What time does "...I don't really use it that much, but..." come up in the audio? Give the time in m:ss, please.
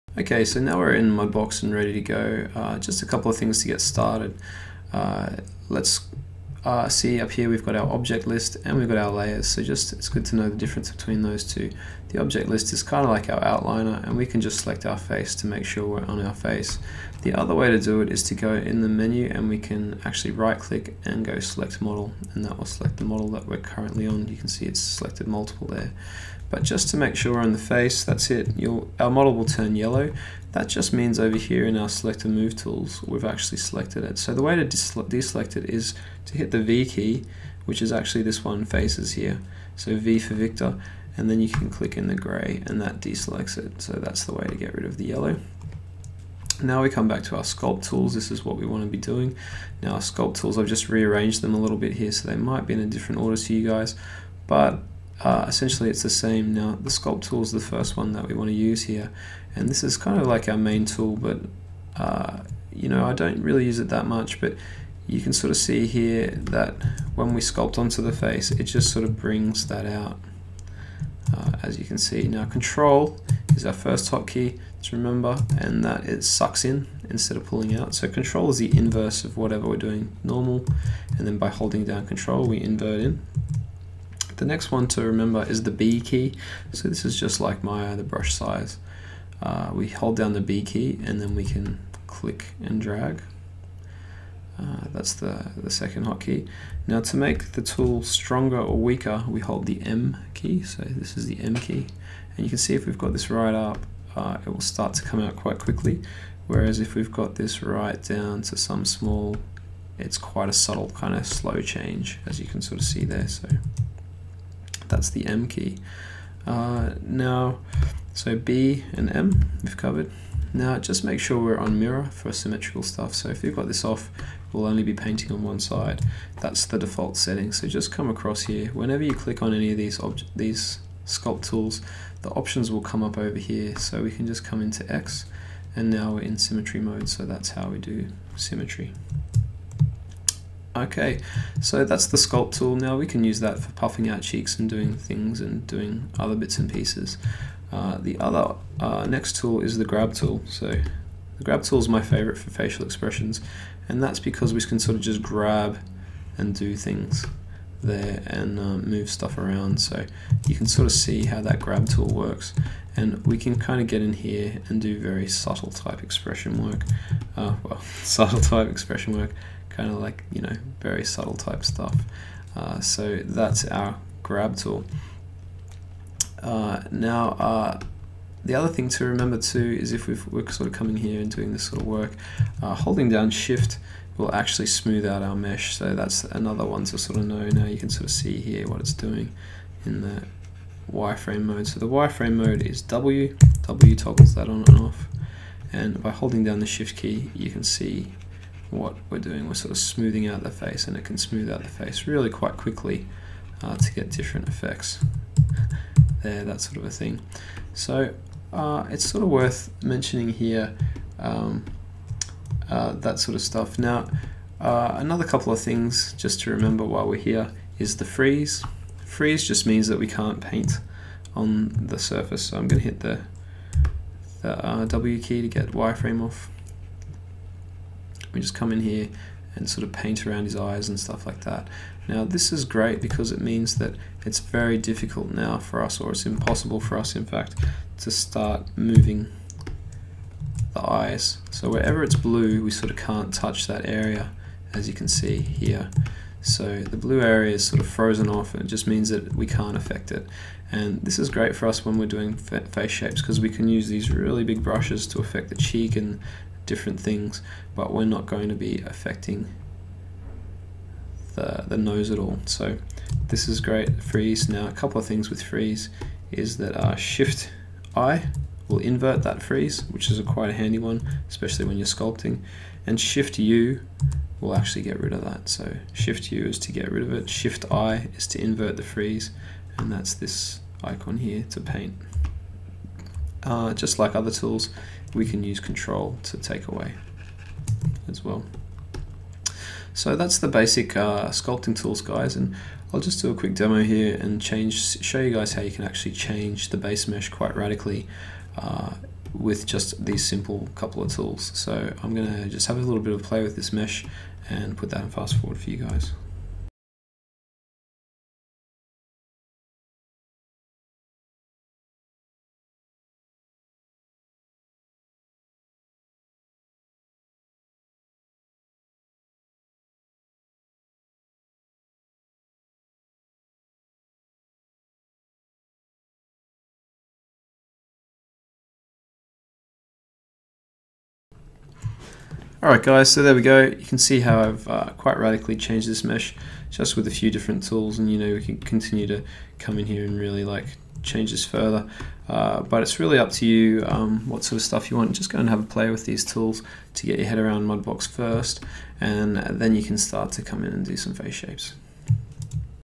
1:03.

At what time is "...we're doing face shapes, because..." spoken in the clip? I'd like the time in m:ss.
4:11.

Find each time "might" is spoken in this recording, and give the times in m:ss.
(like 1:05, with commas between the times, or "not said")
0:52.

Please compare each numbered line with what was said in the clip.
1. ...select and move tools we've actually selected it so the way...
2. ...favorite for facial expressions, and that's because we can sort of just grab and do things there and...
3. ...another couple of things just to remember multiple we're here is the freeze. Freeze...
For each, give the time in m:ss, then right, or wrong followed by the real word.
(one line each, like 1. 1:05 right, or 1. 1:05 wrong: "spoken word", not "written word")
1. 0:31 right
2. 2:32 right
3. 3:34 wrong: "while", not "multiple".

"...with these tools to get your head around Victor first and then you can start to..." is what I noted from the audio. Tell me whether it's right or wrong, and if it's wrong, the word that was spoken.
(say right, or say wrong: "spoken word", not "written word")
wrong: "Mudbox", not "Victor".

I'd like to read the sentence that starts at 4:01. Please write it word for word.
So wherever it's blue, we sort of can't touch that area, as you can see here.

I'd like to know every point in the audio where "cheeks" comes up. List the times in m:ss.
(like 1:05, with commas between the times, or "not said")
2:24, 4:15.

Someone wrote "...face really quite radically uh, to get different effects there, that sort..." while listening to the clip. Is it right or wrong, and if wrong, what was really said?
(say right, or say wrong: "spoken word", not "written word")
wrong: "quickly", not "radically".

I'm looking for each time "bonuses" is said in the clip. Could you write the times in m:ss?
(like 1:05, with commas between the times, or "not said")
not said.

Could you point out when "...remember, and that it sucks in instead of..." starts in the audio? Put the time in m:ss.
1:14.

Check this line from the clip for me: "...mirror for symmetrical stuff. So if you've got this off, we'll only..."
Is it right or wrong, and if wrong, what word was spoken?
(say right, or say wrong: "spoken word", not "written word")
right.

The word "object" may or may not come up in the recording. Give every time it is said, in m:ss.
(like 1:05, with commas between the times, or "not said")
0:07, 0:12.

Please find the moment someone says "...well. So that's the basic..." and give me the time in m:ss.
4:48.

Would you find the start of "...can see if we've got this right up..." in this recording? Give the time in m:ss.
1:42.